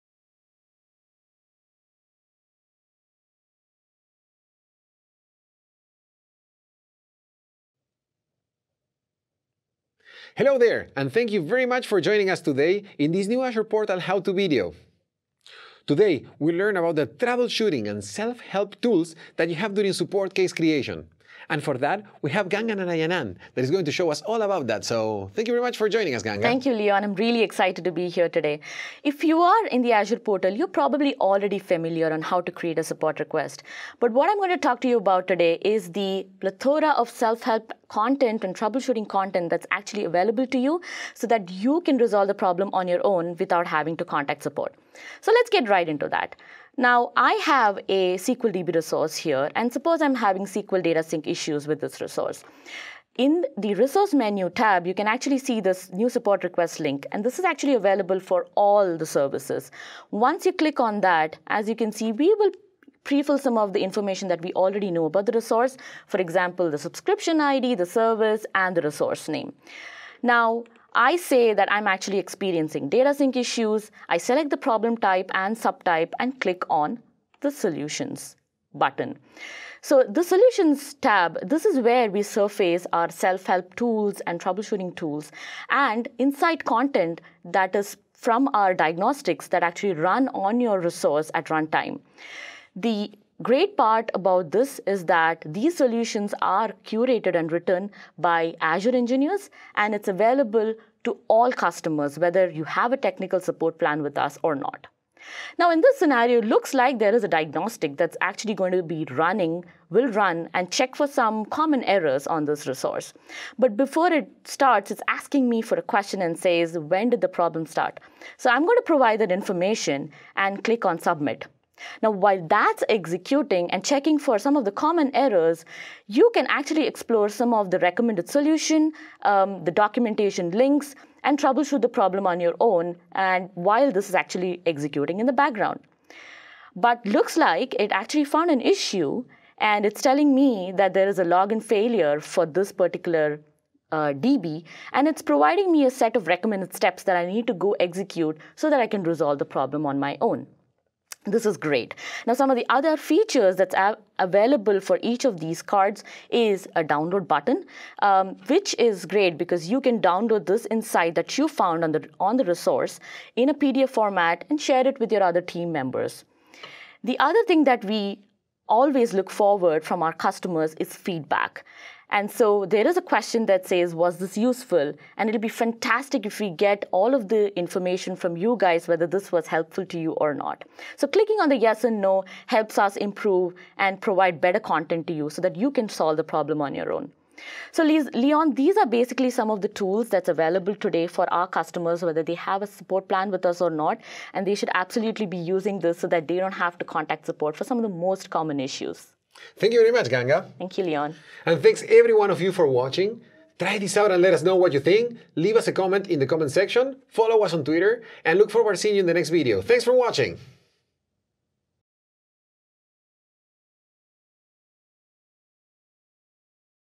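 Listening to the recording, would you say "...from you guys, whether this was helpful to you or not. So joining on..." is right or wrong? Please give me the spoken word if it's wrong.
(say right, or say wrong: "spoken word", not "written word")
wrong: "clicking", not "joining".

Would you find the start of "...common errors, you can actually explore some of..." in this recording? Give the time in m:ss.
2:04.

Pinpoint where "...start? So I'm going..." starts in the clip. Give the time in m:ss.
1:57.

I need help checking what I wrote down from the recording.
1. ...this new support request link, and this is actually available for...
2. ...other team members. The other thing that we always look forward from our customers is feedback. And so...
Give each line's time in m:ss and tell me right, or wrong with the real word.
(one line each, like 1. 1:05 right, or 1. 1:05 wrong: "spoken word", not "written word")
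1. 0:55 right
2. 2:45 right.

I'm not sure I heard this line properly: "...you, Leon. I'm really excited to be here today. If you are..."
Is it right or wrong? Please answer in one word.
right.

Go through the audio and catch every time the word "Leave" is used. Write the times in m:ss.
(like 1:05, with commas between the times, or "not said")
3:25.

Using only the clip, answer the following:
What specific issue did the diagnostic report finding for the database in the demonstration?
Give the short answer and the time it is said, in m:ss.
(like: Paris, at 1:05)
Login failure, at 2:21.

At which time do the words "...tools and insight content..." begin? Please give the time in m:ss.
1:24.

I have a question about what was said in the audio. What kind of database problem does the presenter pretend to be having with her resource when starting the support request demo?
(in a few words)
SQL data sync issues.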